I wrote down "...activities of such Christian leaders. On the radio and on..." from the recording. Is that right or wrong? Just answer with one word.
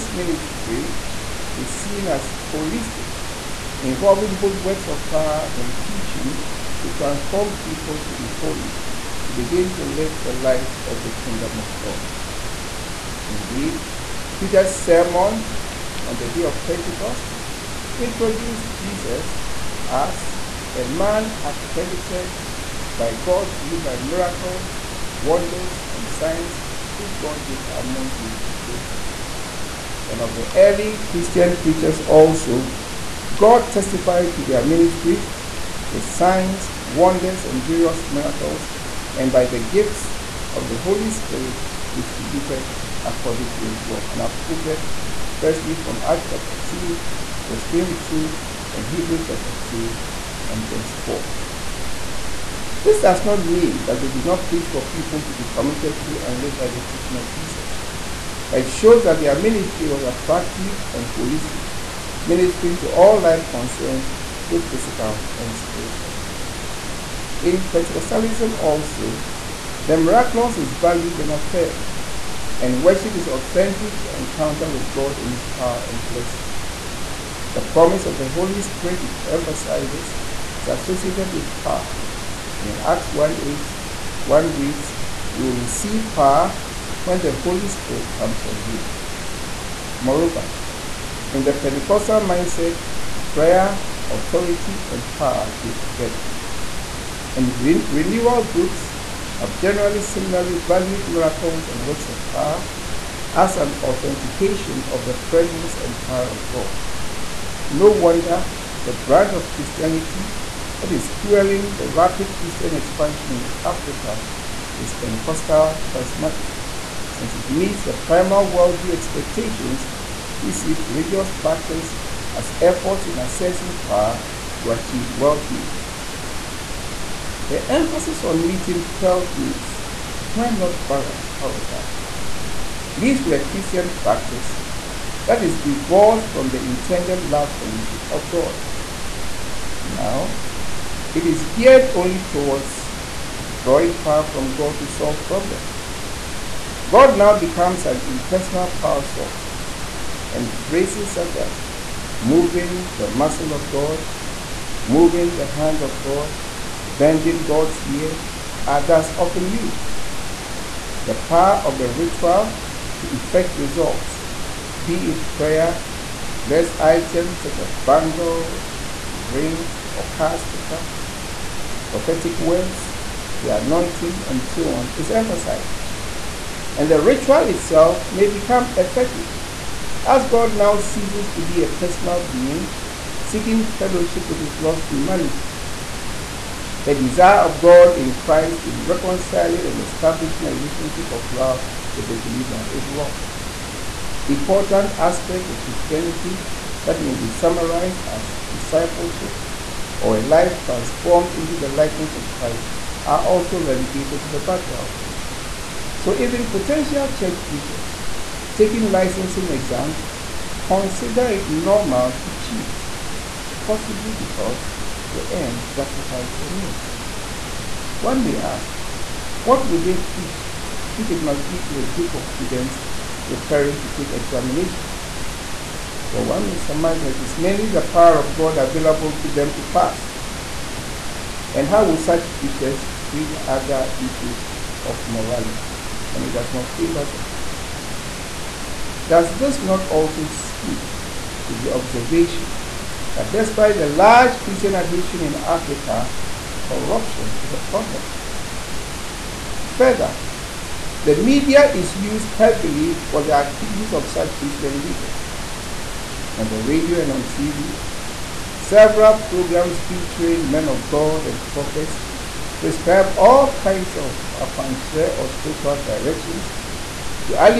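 right.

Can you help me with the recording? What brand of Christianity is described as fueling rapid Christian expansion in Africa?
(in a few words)
Pentecostal charismatic.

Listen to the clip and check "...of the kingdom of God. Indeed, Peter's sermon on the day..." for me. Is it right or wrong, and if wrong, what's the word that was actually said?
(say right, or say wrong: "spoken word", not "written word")
right.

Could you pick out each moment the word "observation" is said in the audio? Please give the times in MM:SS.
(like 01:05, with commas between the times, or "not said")
04:01.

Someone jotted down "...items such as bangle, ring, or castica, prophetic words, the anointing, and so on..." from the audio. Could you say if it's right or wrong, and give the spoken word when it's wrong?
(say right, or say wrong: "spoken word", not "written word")
right.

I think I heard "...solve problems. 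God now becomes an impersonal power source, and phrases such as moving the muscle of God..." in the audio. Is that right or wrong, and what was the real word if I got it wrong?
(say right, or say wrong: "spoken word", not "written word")
right.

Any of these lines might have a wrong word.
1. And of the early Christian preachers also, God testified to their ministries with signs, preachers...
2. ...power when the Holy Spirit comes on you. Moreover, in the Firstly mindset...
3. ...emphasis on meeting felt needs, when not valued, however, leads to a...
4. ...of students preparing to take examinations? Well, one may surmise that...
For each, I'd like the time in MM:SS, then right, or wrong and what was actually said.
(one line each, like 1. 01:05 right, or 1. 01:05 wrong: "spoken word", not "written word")
1. 00:30 wrong: "wonders", not "preachers"
2. 01:26 wrong: "Pentecostal", not "Firstly"
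3. 02:07 wrong: "balanced", not "valued"
4. 03:42 right.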